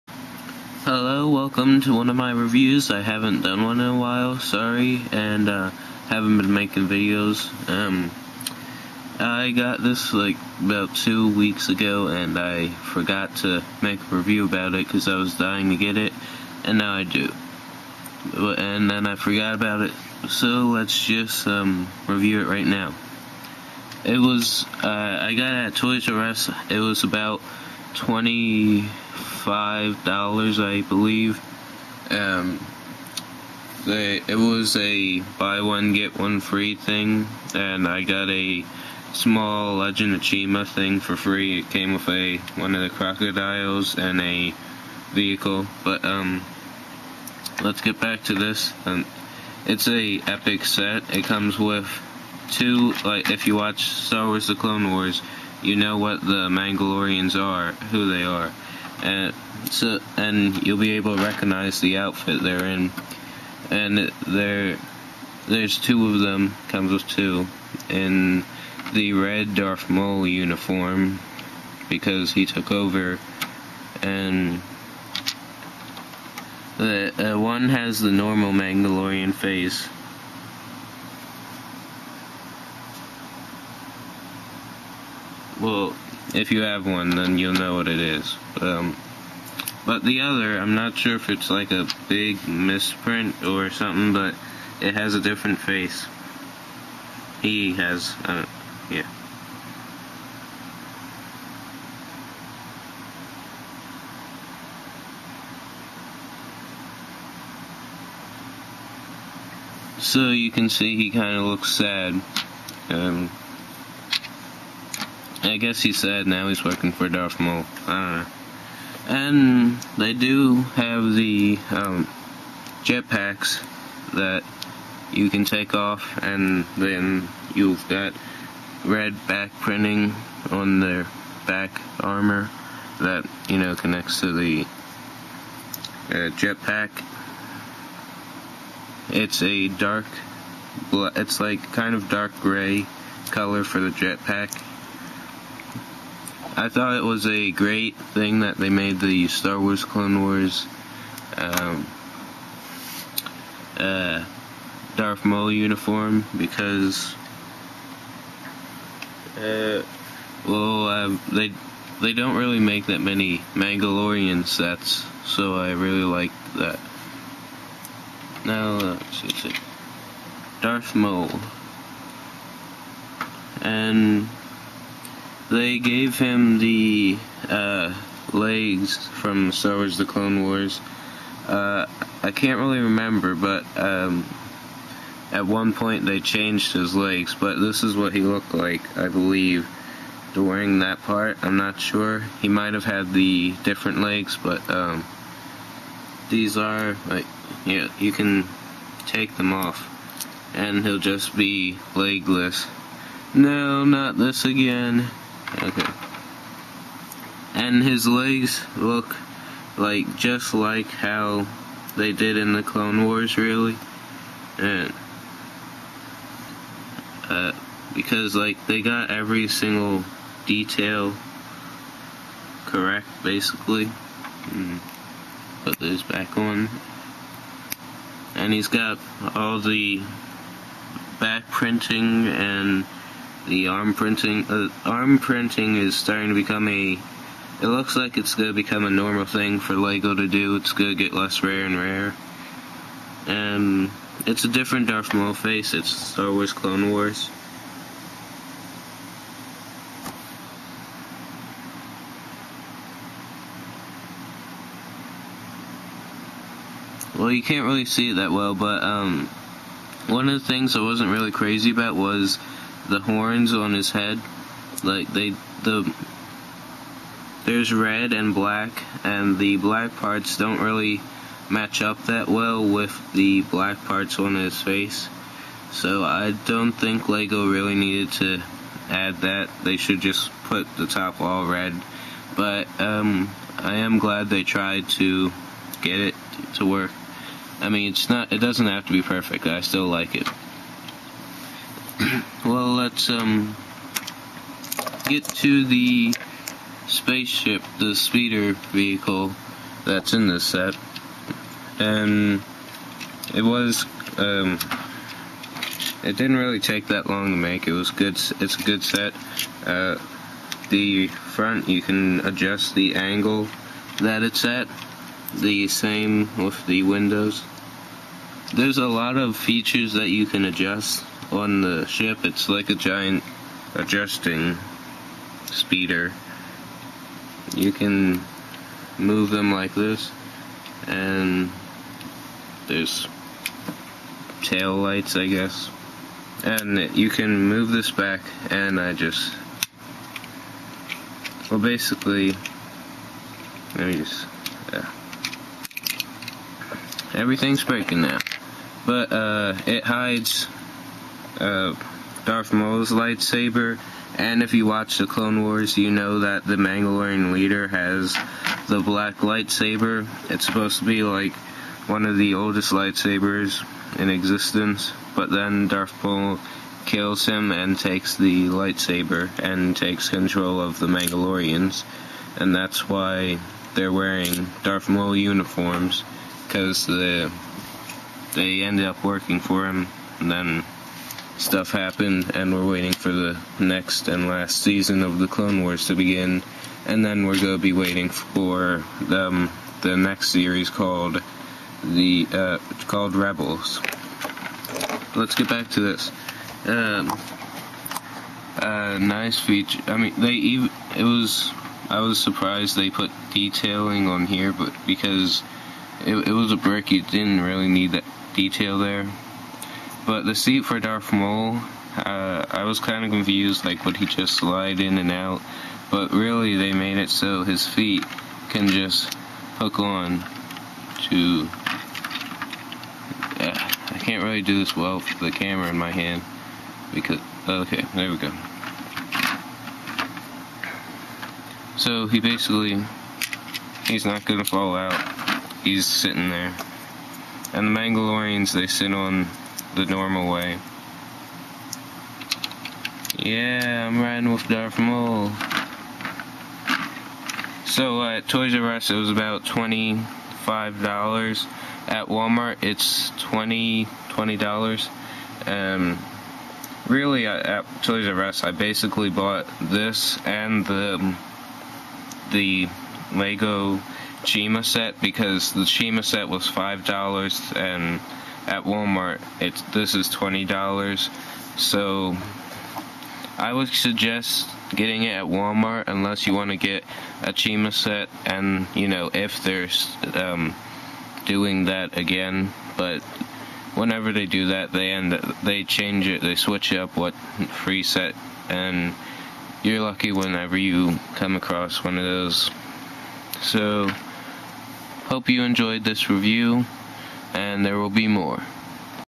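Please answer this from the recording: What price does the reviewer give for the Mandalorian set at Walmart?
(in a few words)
$20.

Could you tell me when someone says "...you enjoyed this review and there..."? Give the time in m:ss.
8:15.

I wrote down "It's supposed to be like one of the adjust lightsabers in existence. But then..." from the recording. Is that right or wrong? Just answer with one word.
wrong.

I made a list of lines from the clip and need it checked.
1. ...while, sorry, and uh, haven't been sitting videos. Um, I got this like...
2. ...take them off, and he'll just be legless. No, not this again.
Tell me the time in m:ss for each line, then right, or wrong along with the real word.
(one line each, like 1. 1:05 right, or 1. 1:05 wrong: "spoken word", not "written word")
1. 0:03 wrong: "making", not "sitting"
2. 3:19 right.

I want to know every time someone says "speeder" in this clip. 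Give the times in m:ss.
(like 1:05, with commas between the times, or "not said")
4:57, 5:25.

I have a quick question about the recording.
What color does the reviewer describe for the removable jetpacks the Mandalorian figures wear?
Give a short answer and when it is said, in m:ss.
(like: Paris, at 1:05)
dark gray, at 2:22.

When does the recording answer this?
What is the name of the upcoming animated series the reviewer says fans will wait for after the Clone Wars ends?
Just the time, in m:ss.
6:33.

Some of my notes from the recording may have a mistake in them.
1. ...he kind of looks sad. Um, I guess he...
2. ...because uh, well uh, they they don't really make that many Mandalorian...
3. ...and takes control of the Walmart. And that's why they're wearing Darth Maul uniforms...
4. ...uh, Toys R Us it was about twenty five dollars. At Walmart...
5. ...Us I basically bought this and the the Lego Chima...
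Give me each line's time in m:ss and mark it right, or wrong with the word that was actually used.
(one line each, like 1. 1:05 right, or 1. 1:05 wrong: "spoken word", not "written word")
1. 1:50 right
2. 2:36 right
3. 6:09 wrong: "Mandalorians", not "Walmart"
4. 7:28 right
5. 7:38 right.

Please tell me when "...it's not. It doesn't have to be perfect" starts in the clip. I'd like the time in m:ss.
4:47.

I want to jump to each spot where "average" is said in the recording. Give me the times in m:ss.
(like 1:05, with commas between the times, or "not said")
not said.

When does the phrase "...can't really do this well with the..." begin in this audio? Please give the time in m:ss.
7:03.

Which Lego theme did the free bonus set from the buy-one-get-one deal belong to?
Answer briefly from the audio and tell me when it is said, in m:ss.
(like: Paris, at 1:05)
Legend of Chima, at 0:39.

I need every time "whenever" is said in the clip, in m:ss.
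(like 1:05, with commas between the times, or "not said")
8:03, 8:10.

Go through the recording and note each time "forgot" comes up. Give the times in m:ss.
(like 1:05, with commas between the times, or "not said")
0:12, 0:19.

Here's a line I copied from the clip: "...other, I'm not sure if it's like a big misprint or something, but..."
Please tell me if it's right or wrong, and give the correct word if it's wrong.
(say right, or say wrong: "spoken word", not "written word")
right.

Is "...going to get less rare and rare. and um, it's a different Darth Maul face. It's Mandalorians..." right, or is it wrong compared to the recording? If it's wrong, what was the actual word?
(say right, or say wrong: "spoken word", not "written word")
wrong: "Star", not "Mandalorians".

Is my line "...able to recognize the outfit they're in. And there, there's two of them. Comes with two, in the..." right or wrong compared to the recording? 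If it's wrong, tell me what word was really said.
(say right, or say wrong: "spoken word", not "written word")
right.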